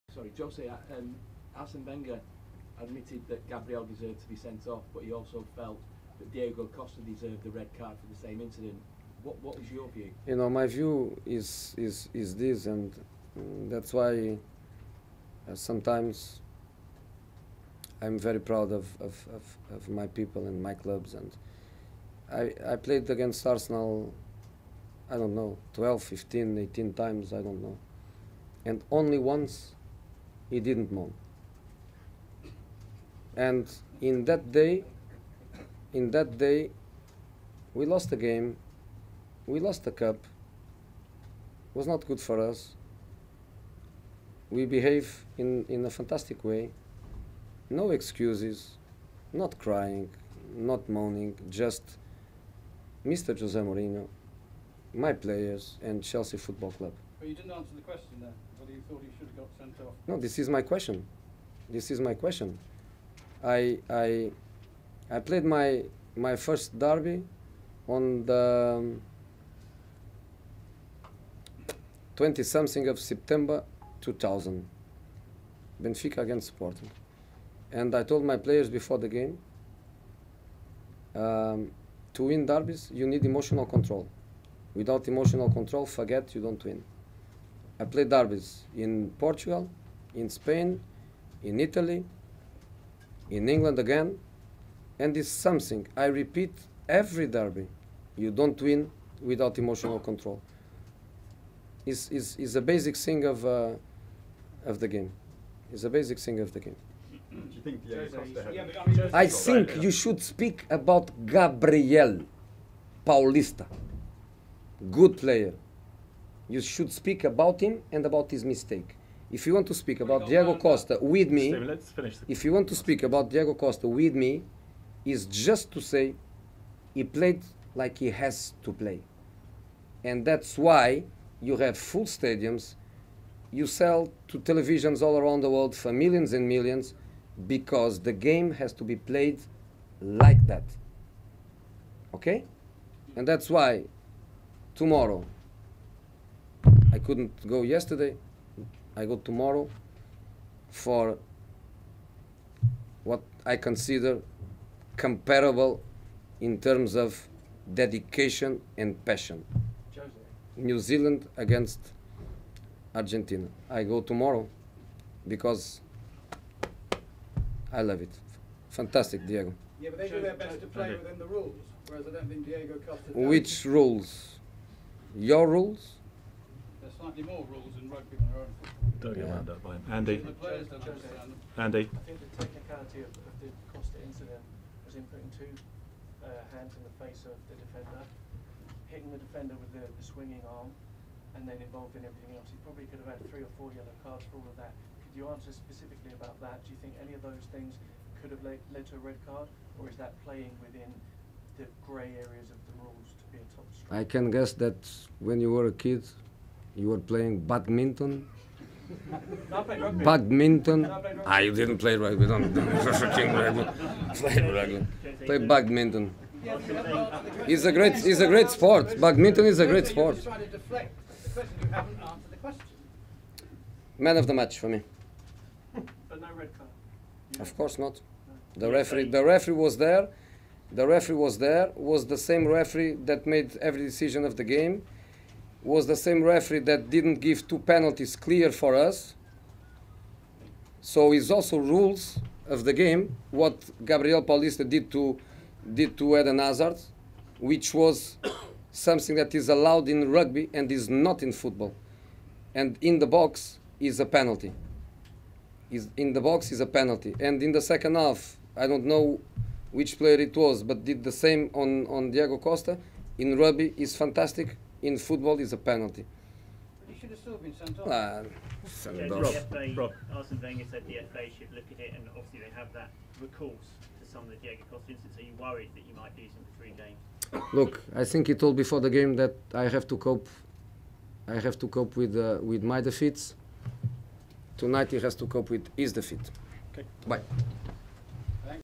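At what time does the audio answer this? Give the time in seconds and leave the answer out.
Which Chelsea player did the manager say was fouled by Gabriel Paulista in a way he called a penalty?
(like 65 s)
246 s.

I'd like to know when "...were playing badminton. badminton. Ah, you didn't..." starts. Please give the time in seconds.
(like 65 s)
206 s.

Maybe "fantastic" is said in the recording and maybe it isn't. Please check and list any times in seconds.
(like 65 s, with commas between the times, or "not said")
45 s, 168 s, 263 s.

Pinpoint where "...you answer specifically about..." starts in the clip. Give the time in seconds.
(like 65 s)
195 s.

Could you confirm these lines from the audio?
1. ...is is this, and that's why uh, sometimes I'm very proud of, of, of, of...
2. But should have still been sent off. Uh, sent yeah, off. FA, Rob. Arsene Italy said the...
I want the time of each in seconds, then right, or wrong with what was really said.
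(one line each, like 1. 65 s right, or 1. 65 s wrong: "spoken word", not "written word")
1. 11 s right
2. 266 s wrong: "Wenger", not "Italy".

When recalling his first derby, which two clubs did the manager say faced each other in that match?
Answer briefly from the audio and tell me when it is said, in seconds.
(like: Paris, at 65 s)
Benfica against Sporting, at 75 s.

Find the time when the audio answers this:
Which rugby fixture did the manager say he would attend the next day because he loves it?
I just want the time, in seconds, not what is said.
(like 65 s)
160 s.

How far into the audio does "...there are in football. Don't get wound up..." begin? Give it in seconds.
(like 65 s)
178 s.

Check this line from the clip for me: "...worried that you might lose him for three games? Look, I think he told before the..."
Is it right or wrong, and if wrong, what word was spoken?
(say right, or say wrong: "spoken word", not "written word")
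right.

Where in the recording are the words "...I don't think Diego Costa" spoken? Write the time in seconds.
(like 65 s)
172 s.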